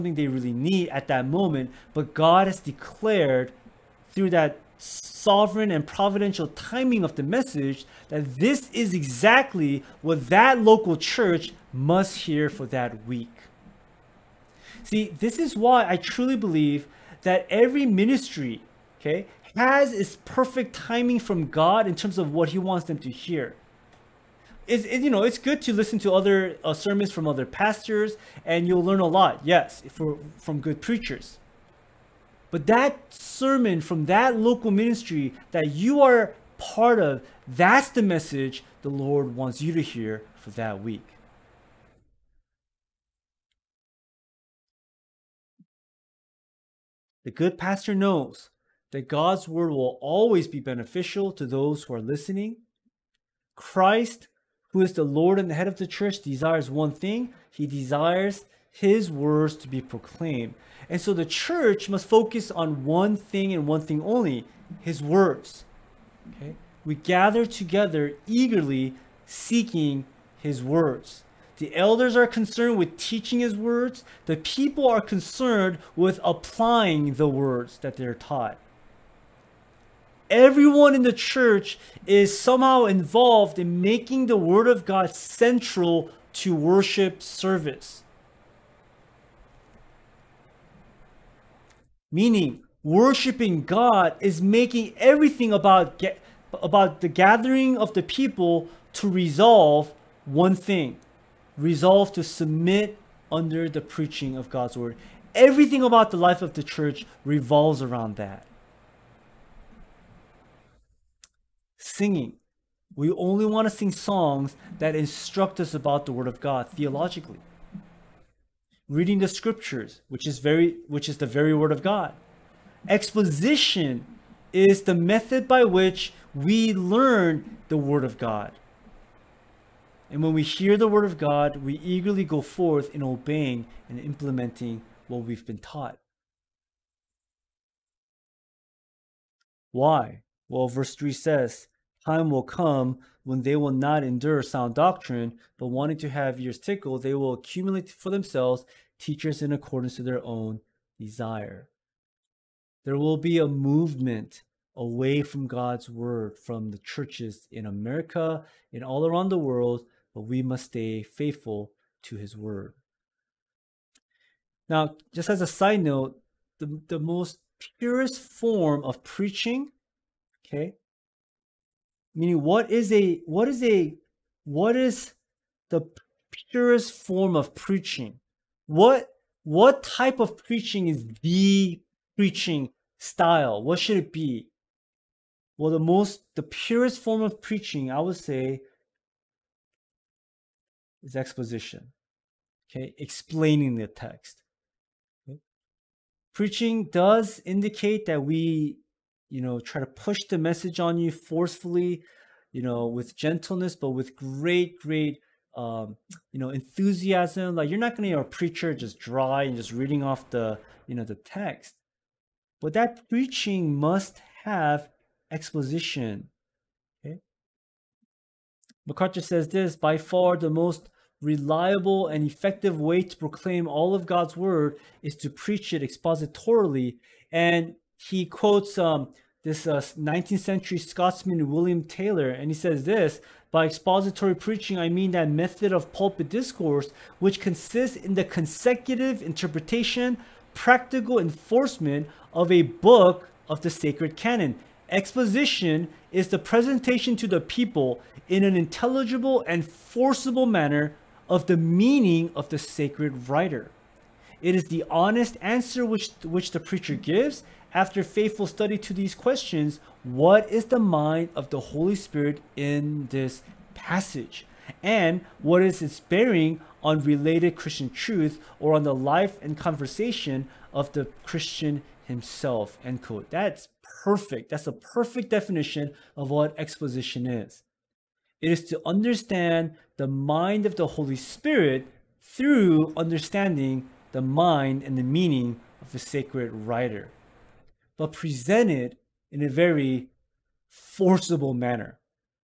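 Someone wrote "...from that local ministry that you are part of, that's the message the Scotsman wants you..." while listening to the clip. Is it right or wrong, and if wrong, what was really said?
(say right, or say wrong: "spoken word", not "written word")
wrong: "Lord", not "Scotsman".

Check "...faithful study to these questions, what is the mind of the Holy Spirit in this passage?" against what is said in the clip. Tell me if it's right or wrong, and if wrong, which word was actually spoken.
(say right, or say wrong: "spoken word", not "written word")
right.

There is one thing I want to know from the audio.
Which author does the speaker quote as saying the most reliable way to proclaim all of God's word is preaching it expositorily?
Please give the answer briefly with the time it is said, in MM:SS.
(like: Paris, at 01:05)
MacArthur, at 03:38.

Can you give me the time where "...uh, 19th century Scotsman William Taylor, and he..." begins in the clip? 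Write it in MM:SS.
03:49.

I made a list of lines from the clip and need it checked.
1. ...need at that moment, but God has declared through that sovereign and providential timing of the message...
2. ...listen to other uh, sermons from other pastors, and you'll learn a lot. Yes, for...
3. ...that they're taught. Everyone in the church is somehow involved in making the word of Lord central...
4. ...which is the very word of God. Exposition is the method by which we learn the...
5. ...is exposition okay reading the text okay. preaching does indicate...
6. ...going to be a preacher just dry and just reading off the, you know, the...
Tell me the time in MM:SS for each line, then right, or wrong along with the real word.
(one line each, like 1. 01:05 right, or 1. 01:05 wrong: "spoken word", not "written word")
1. 00:00 right
2. 00:25 right
3. 01:17 wrong: "God", not "Lord"
4. 02:00 right
5. 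03:11 wrong: "explaining", not "reading"
6. 03:27 right.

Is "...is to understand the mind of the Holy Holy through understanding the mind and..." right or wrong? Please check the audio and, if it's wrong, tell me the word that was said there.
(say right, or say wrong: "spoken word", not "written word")
wrong: "Spirit", not "Holy".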